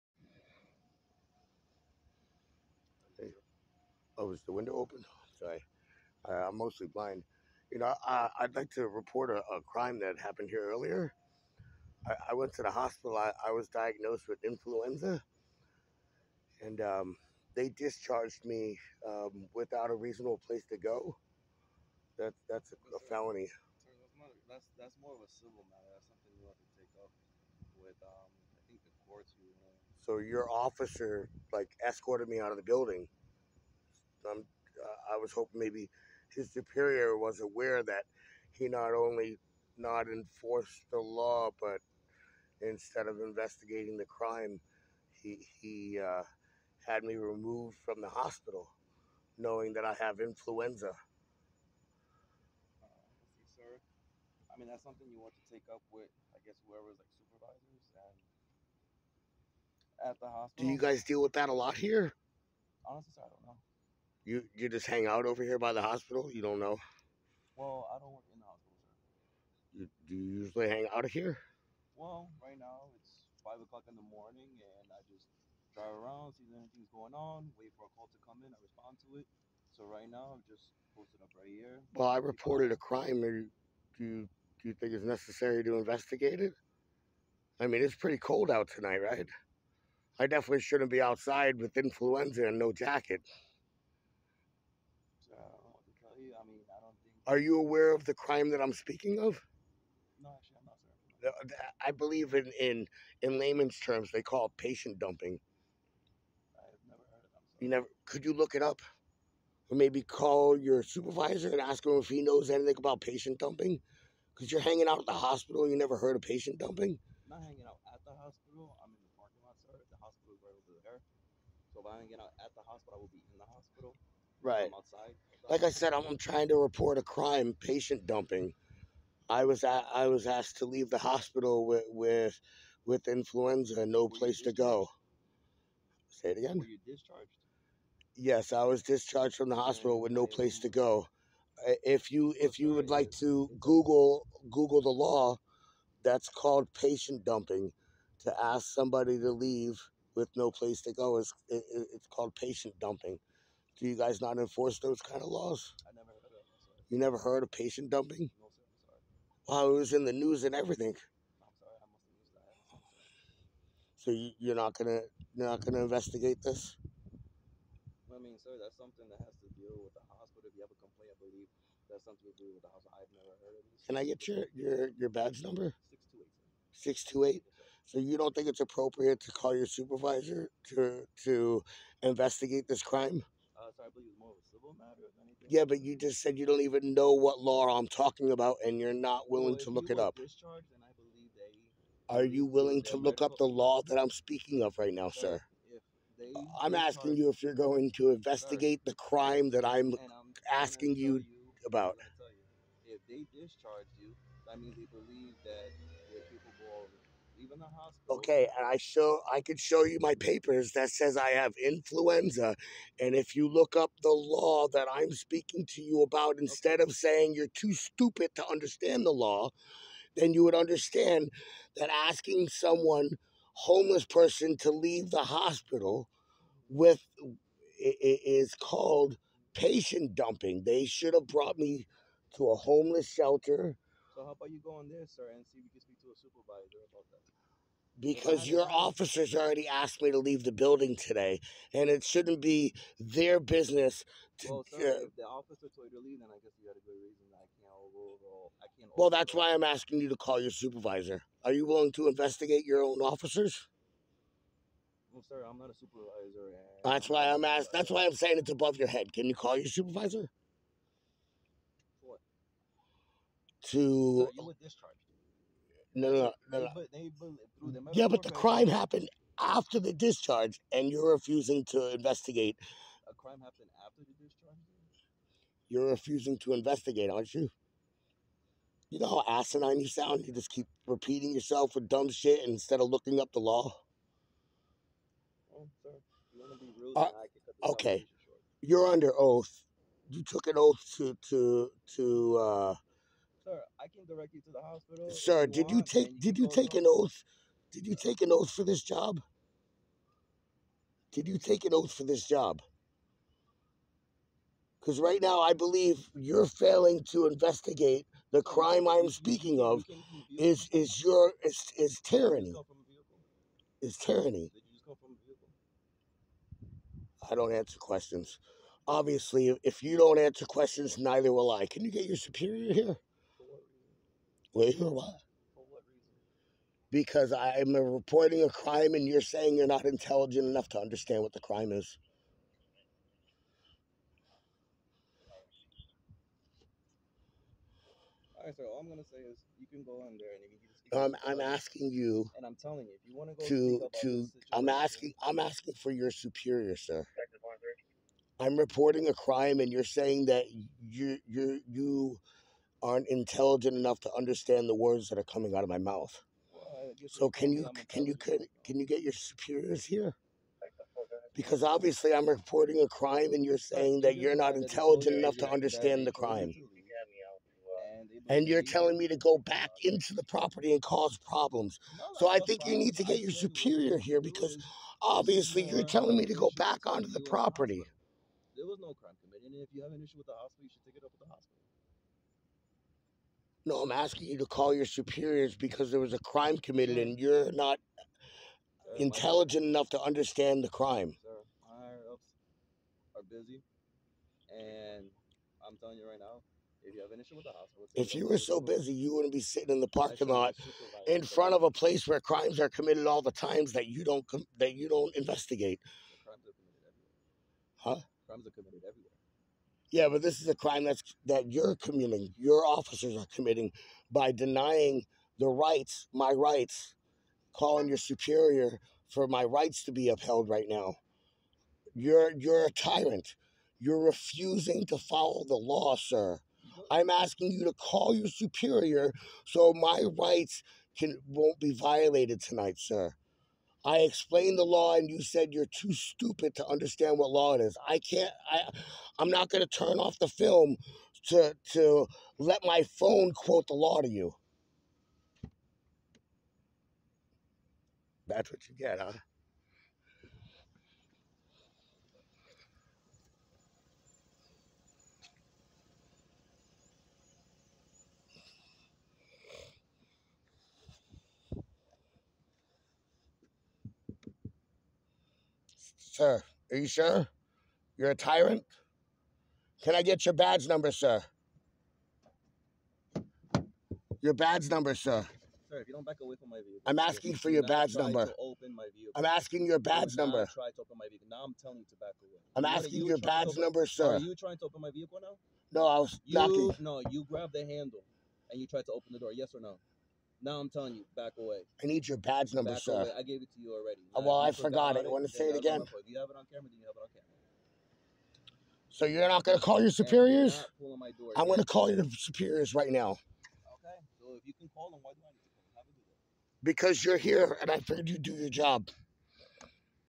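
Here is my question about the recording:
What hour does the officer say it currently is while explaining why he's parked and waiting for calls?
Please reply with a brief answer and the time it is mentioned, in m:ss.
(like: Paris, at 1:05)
5 o'clock in the morning, at 1:13.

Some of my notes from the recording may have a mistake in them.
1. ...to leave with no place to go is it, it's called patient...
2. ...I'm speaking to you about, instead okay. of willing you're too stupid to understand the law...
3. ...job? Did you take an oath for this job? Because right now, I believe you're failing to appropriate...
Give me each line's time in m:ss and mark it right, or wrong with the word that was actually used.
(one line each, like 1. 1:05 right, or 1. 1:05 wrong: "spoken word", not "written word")
1. 2:29 right
2. 3:34 wrong: "saying", not "willing"
3. 4:58 wrong: "investigate", not "appropriate".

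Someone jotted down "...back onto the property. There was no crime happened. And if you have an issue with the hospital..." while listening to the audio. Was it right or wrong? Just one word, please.
wrong.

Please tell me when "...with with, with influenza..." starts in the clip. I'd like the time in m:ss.
2:11.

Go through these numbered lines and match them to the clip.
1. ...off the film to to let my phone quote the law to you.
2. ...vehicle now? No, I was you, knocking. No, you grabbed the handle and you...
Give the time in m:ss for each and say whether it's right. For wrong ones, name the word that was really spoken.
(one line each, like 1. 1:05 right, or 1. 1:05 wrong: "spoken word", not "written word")
1. 7:19 right
2. 8:04 right.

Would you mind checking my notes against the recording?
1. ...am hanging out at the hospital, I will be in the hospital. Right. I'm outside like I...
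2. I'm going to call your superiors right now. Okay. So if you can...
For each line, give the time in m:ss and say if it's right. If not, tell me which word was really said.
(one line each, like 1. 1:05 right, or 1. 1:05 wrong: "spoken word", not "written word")
1. 2:02 right
2. 8:21 right.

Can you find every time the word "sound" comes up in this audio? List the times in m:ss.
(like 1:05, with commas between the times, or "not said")
4:39.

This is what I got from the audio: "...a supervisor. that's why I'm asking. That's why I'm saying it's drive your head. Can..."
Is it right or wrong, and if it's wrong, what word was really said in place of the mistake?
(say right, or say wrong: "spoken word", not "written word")
wrong: "above", not "drive".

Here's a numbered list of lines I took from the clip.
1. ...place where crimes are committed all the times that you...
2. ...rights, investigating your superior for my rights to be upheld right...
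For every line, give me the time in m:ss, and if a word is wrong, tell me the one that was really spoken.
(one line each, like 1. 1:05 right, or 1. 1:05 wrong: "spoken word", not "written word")
1. 6:41 right
2. 6:56 wrong: "calling", not "investigating".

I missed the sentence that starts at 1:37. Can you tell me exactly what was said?
Are you aware of the crime that I'm speaking of?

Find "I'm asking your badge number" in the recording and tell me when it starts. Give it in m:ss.
7:59.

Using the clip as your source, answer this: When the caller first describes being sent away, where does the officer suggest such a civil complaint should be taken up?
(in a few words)
the courts.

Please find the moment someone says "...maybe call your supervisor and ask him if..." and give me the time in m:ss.
1:49.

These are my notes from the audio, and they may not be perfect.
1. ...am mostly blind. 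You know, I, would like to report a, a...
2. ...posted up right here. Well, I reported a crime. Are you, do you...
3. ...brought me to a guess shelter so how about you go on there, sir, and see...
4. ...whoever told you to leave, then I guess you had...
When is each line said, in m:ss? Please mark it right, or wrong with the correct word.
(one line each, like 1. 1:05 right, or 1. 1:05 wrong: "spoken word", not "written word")
1. 0:06 right
2. 1:20 right
3. 3:51 wrong: "homeless", not "guess"
4. 4:05 wrong: "officer", not "whoever".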